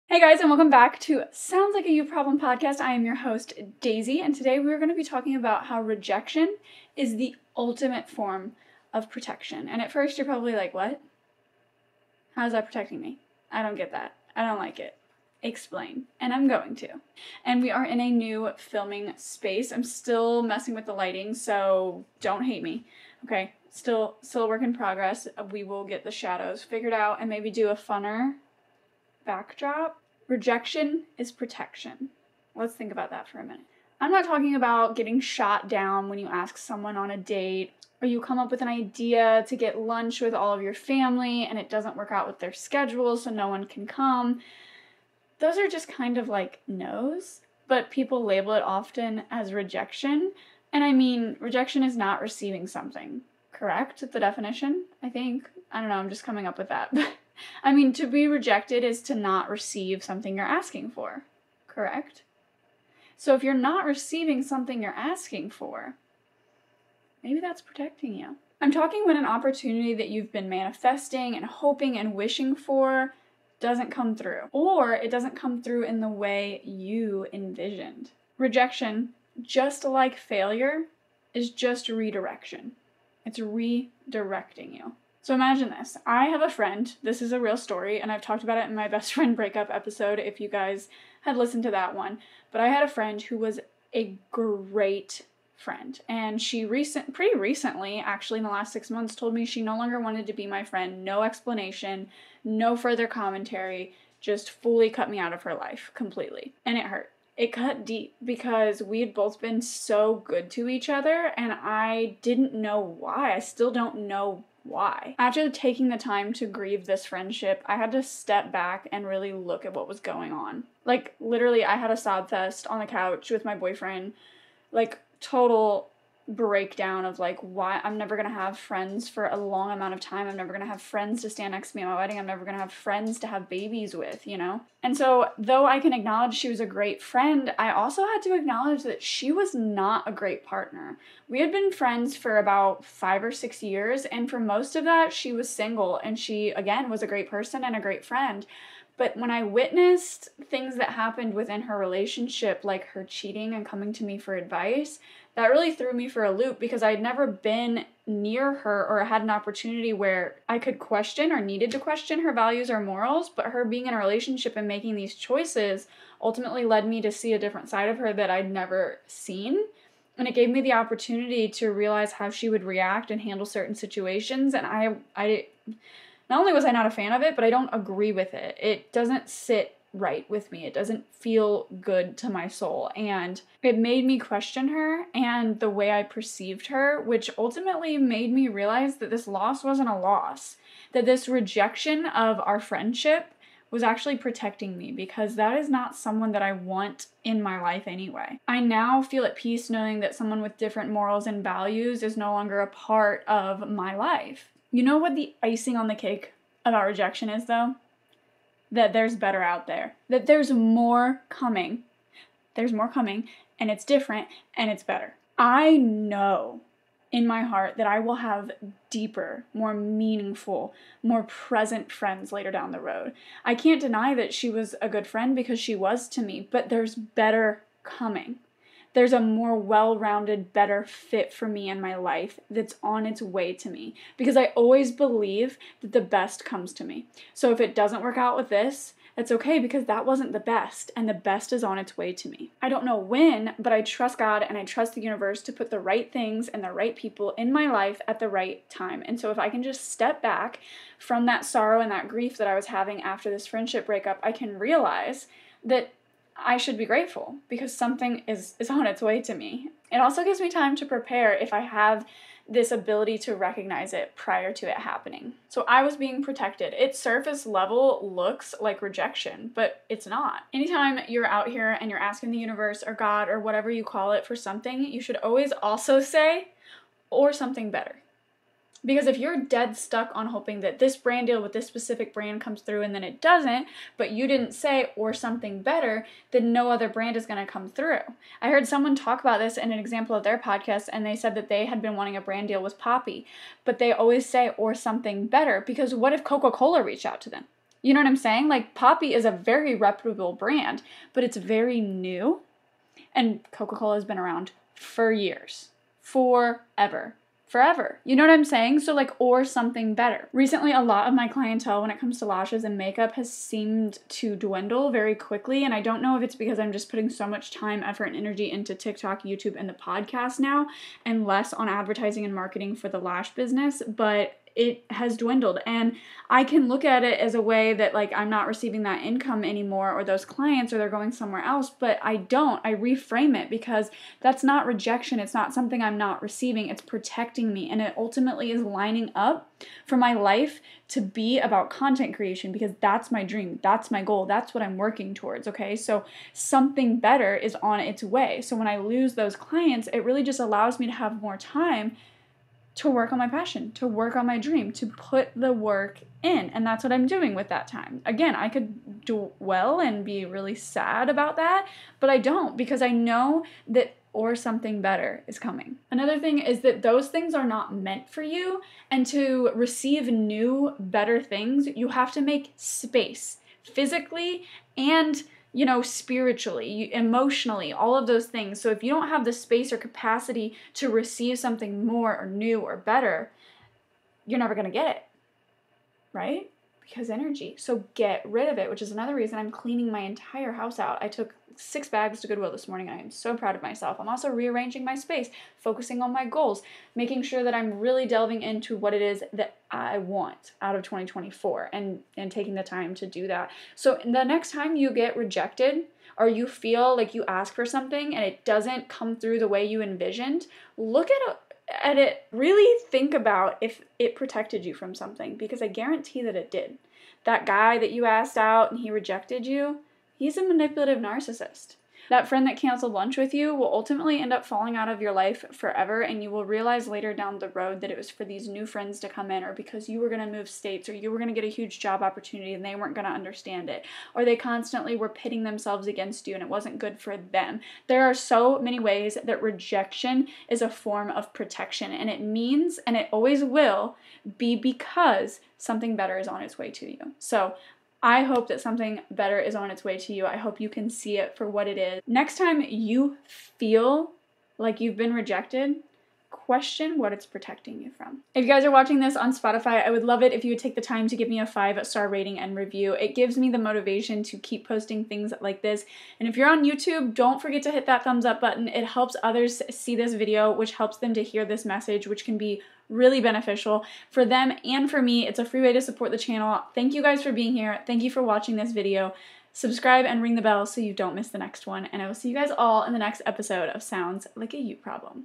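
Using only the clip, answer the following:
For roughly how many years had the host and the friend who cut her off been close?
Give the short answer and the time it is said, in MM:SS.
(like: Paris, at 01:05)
5 or 6 years, at 02:22.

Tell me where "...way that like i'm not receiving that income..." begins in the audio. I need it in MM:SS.
05:27.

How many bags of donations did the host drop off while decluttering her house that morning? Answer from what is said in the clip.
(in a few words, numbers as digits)
6.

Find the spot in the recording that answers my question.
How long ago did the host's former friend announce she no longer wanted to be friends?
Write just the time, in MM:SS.
01:38.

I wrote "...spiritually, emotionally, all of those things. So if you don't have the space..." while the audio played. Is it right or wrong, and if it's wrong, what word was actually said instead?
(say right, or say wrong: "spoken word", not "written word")
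right.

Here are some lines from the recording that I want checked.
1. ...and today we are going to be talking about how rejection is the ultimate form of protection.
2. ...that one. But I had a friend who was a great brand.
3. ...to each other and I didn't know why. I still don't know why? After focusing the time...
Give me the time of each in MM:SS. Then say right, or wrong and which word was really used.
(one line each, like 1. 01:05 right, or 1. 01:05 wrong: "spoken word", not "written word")
1. 00:04 right
2. 01:31 wrong: "friend", not "brand"
3. 01:50 wrong: "taking", not "focusing".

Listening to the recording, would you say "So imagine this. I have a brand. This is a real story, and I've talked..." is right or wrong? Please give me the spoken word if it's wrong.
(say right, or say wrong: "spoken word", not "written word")
wrong: "friend", not "brand".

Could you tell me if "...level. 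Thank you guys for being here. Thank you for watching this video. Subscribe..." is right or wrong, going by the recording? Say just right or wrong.
wrong.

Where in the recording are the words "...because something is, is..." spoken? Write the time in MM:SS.
04:17.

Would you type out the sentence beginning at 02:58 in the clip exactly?
It doesn't sit right with me.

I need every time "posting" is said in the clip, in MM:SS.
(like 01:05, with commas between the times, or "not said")
07:44.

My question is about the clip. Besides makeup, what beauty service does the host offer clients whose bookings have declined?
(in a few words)
Lashes.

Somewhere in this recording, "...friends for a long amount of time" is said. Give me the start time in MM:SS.
02:08.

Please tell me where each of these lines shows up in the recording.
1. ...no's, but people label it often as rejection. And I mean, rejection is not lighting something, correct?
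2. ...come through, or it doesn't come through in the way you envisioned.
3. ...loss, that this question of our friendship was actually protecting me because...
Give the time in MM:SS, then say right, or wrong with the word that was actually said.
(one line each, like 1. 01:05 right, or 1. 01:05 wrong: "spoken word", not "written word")
1. 00:46 wrong: "receiving", not "lighting"
2. 01:13 right
3. 03:09 wrong: "rejection", not "question".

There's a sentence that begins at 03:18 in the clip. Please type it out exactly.
I now feel at peace knowing that someone with different morals and values is no longer a part of my life.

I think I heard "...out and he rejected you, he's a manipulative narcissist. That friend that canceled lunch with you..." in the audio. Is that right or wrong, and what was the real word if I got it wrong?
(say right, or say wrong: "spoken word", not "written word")
right.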